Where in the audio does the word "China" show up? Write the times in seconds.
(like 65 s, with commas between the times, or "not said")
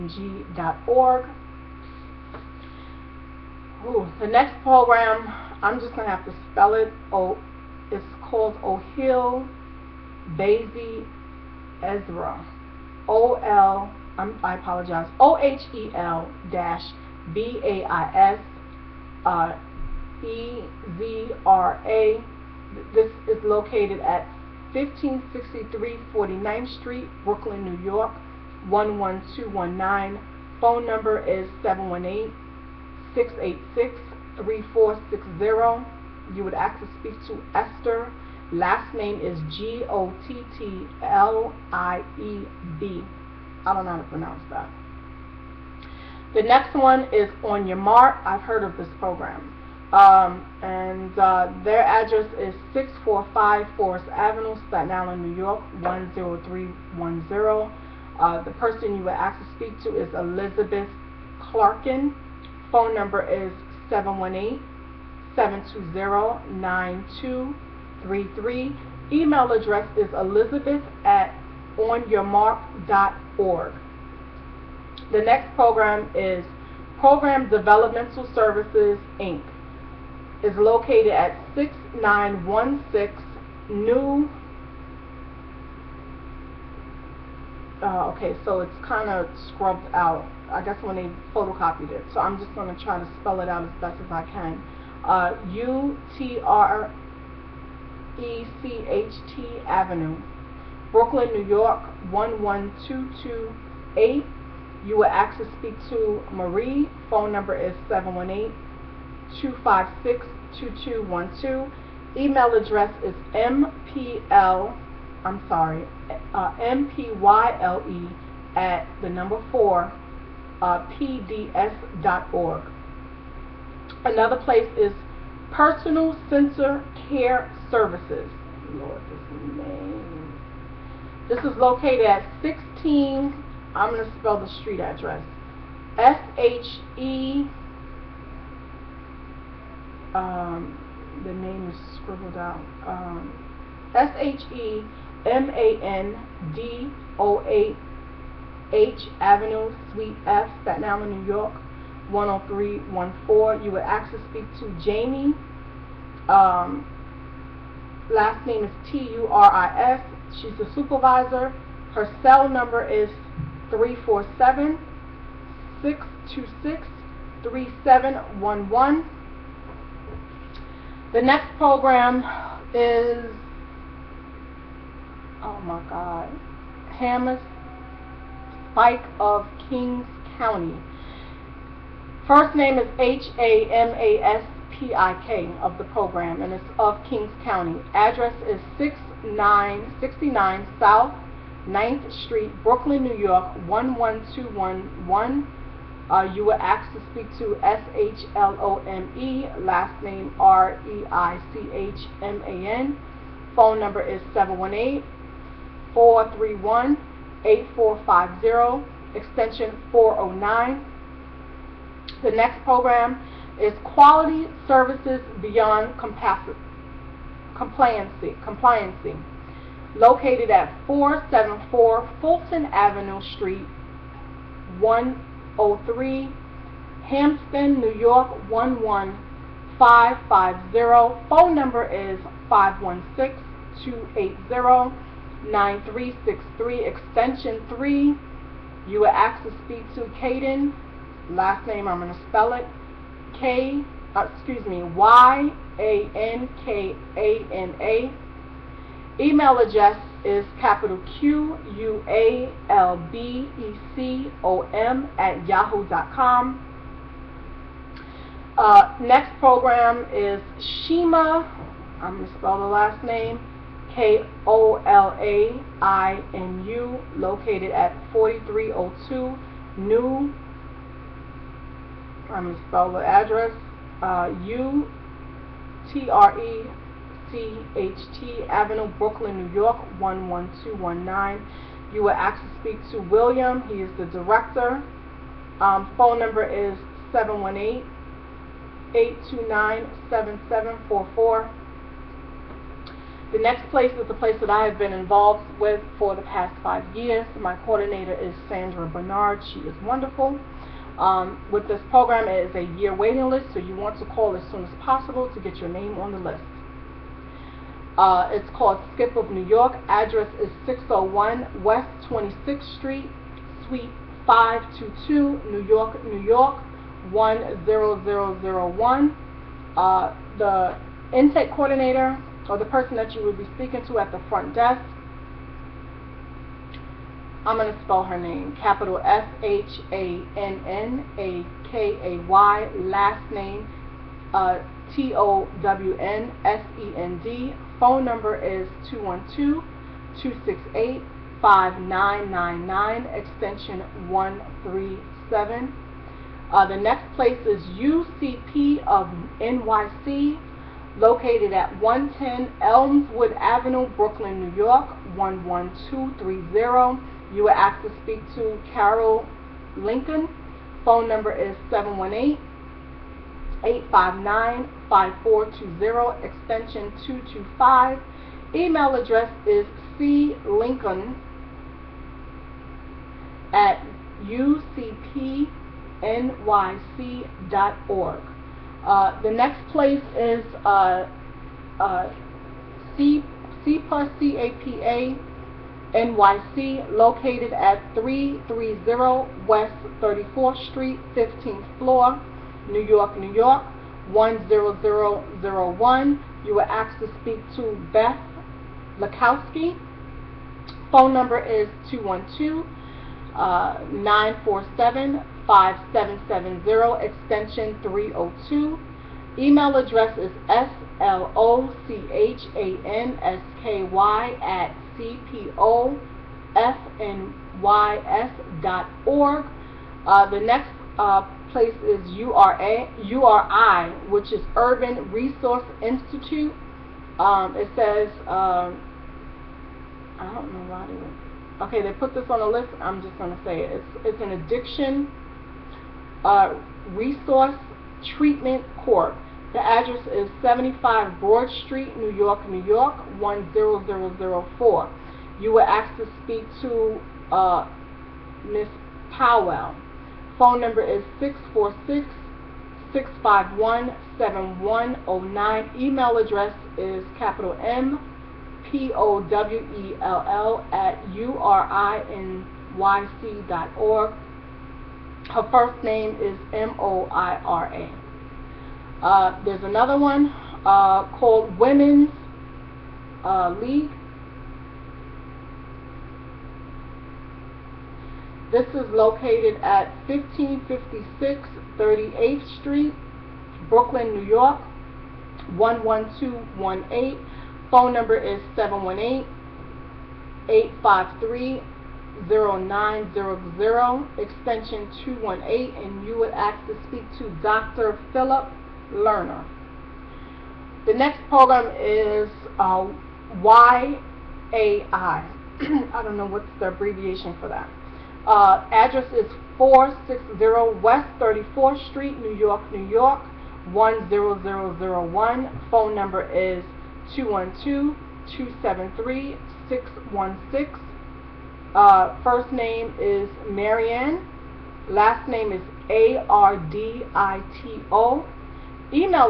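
not said.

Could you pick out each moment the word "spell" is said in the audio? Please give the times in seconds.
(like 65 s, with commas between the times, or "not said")
6 s, 93 s, 134 s, 242 s, 262 s, 272 s, 327 s.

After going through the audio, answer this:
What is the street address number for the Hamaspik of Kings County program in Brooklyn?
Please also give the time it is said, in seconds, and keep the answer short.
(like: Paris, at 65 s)
6969, at 188 s.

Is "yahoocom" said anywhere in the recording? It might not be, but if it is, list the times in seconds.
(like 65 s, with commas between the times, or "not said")
255 s.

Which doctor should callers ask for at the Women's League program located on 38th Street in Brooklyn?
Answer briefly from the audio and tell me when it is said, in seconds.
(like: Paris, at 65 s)
Dr. Philip Learner, at 497 s.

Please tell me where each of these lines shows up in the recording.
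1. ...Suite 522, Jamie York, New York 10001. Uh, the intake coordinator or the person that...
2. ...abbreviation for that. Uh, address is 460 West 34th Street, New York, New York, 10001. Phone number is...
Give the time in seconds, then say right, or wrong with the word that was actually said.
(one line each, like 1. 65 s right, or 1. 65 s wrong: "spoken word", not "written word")
1. 313 s wrong: "New", not "Jamie"
2. 506 s right.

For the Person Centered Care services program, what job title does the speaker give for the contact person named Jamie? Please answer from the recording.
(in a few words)
Supervisor.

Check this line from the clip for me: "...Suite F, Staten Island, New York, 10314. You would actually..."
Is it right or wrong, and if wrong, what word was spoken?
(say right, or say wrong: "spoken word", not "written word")
right.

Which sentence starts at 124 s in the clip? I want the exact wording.
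Another place is Person Centered Care services.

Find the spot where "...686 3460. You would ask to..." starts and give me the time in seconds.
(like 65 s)
33 s.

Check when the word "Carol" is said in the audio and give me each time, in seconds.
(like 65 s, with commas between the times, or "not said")
358 s.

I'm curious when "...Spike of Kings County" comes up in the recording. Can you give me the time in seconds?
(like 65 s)
178 s.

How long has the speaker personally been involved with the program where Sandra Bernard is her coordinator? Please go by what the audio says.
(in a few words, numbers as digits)
5 years.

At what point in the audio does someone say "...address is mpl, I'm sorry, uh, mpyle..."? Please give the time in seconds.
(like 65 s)
112 s.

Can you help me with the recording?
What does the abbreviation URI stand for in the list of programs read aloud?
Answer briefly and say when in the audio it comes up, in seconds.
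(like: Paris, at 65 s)
Urban Resource Institute, at 424 s.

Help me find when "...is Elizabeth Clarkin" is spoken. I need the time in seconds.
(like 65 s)
59 s.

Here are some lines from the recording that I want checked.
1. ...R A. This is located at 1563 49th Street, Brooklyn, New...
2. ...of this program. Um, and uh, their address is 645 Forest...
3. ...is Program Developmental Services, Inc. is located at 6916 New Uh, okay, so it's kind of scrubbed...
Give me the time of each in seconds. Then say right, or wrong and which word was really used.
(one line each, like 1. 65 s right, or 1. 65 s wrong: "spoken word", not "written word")
1. 21 s right
2. 48 s right
3. 76 s right.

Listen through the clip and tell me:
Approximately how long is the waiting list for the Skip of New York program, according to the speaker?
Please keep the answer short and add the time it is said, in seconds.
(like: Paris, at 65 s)
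A year, at 302 s.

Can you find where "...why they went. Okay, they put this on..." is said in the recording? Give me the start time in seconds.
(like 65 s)
430 s.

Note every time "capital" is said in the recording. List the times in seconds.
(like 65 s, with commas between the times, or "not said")
250 s, 328 s, 457 s.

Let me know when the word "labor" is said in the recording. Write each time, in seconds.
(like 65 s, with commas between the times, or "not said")
not said.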